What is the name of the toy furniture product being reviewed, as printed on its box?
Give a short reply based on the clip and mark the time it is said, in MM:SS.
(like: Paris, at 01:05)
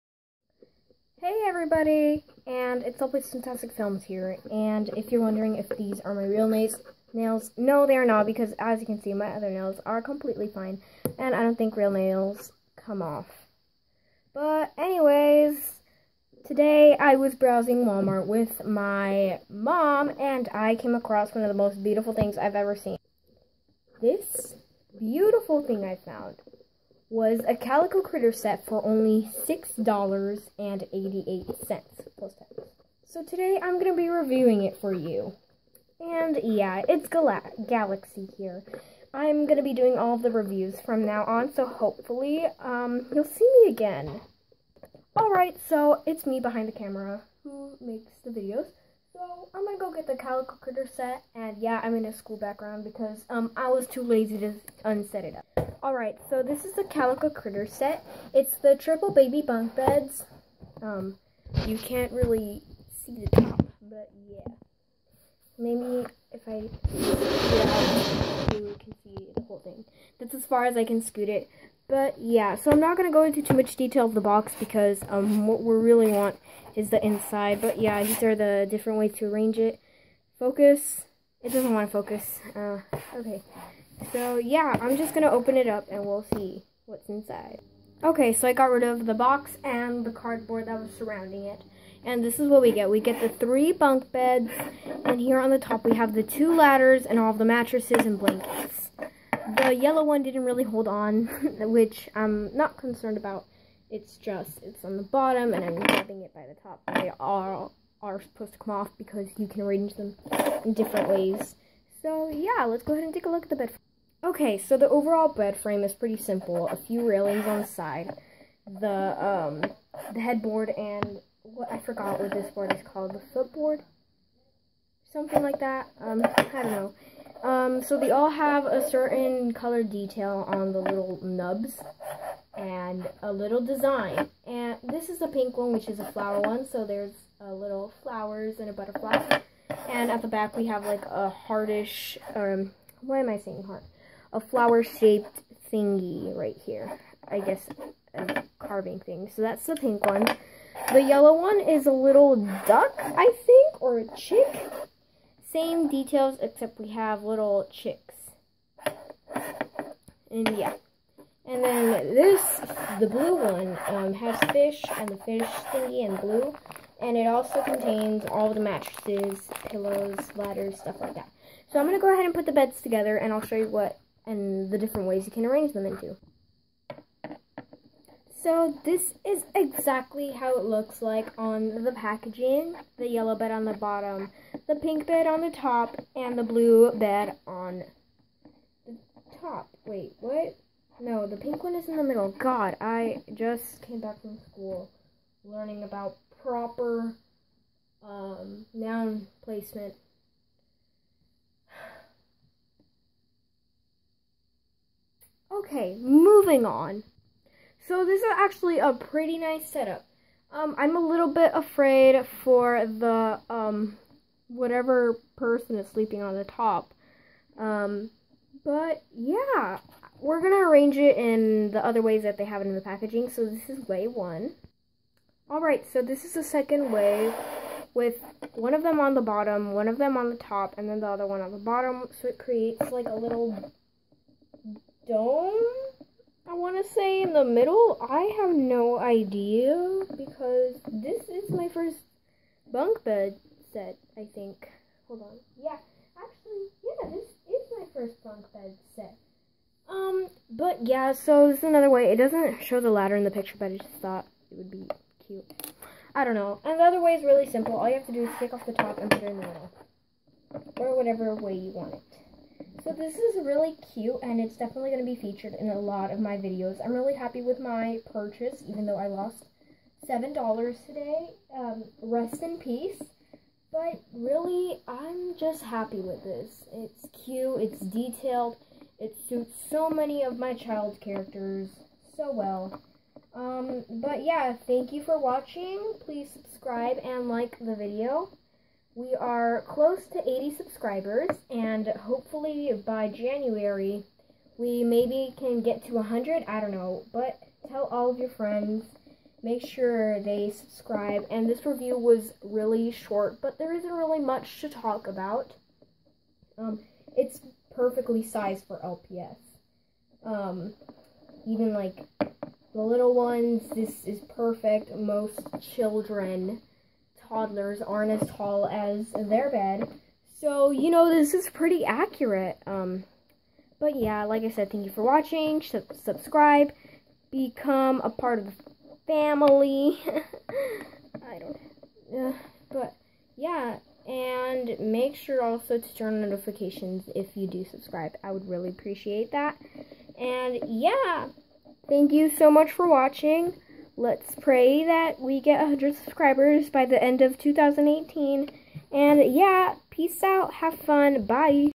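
triple baby bunk beds, at 00:58.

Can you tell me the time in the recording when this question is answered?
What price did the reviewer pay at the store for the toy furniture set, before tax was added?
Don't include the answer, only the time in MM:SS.
00:29.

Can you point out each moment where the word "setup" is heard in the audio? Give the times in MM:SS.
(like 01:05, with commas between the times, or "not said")
03:29.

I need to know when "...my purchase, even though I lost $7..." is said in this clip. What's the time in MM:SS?
04:27.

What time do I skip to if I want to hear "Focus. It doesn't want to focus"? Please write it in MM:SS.
01:20.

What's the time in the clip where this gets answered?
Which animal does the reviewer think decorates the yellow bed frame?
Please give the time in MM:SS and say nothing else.
02:32.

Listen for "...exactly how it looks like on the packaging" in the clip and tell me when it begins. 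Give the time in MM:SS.
02:59.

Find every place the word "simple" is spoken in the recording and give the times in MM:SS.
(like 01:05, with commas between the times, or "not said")
01:56, 04:17.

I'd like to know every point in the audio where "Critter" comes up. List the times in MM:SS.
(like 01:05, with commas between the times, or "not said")
00:28, 00:50, 00:57.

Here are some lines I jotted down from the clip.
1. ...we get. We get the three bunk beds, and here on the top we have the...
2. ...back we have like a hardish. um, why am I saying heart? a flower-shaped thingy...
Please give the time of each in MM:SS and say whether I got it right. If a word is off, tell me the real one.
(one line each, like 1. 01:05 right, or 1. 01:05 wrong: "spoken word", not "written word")
1. 01:32 right
2. 02:20 right.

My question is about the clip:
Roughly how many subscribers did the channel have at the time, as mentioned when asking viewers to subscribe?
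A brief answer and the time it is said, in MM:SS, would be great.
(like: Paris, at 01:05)
80, at 04:50.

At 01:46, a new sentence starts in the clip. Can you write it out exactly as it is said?
They are, are supposed to come off because you can arrange them in different ways.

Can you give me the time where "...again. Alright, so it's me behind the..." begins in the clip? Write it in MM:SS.
00:43.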